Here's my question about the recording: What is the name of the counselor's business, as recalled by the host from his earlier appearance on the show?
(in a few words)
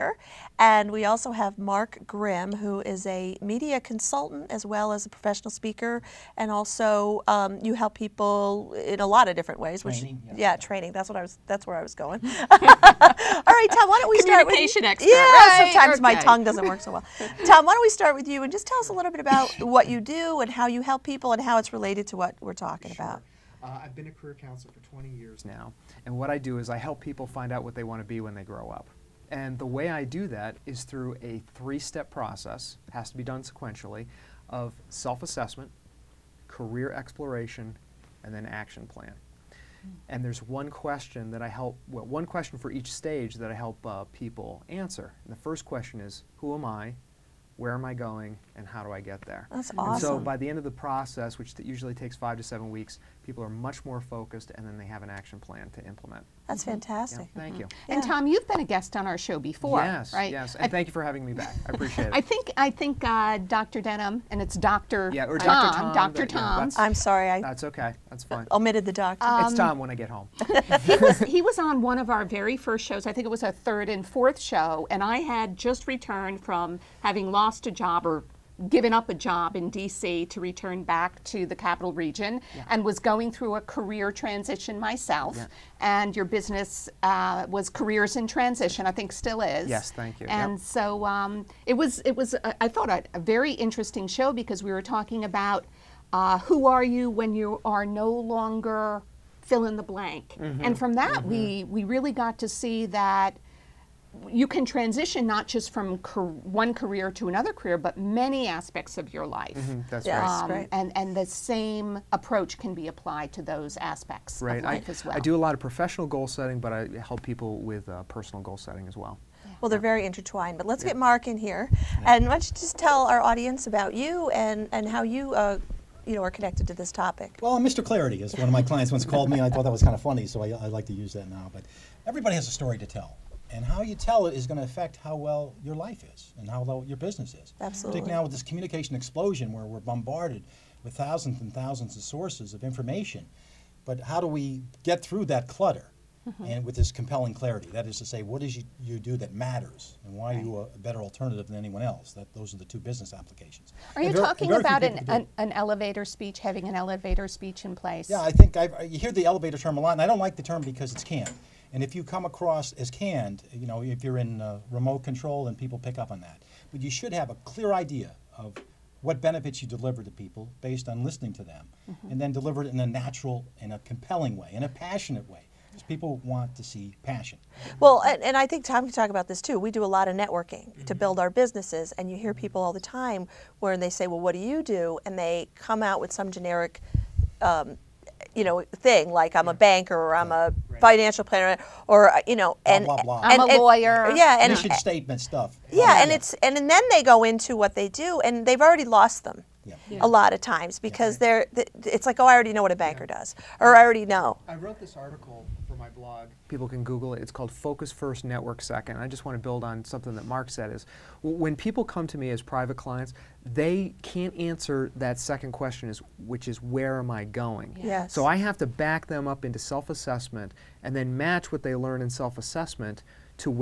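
Careers in Transition.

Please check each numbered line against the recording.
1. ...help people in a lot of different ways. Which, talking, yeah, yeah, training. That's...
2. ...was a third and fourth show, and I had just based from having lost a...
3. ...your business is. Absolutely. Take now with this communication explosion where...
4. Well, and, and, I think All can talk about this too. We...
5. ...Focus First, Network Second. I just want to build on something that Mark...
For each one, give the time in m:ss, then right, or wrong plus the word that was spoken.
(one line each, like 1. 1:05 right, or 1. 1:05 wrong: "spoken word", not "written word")
1. 0:07 wrong: "training", not "talking"
2. 1:13 wrong: "returned", not "based"
3. 2:16 right
4. 2:57 wrong: "Tom", not "All"
5. 3:27 right.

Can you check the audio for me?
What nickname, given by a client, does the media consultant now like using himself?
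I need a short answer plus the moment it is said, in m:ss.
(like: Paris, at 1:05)
Mr. Clarity, at 2:07.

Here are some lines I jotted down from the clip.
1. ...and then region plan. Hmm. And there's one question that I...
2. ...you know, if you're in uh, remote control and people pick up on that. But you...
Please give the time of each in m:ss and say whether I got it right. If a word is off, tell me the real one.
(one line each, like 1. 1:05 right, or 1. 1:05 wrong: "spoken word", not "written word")
1. 0:38 wrong: "action", not "region"
2. 2:43 right.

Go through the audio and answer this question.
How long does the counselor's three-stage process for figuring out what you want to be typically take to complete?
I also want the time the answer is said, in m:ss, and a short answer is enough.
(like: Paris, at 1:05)
5 to 7 weeks, at 0:52.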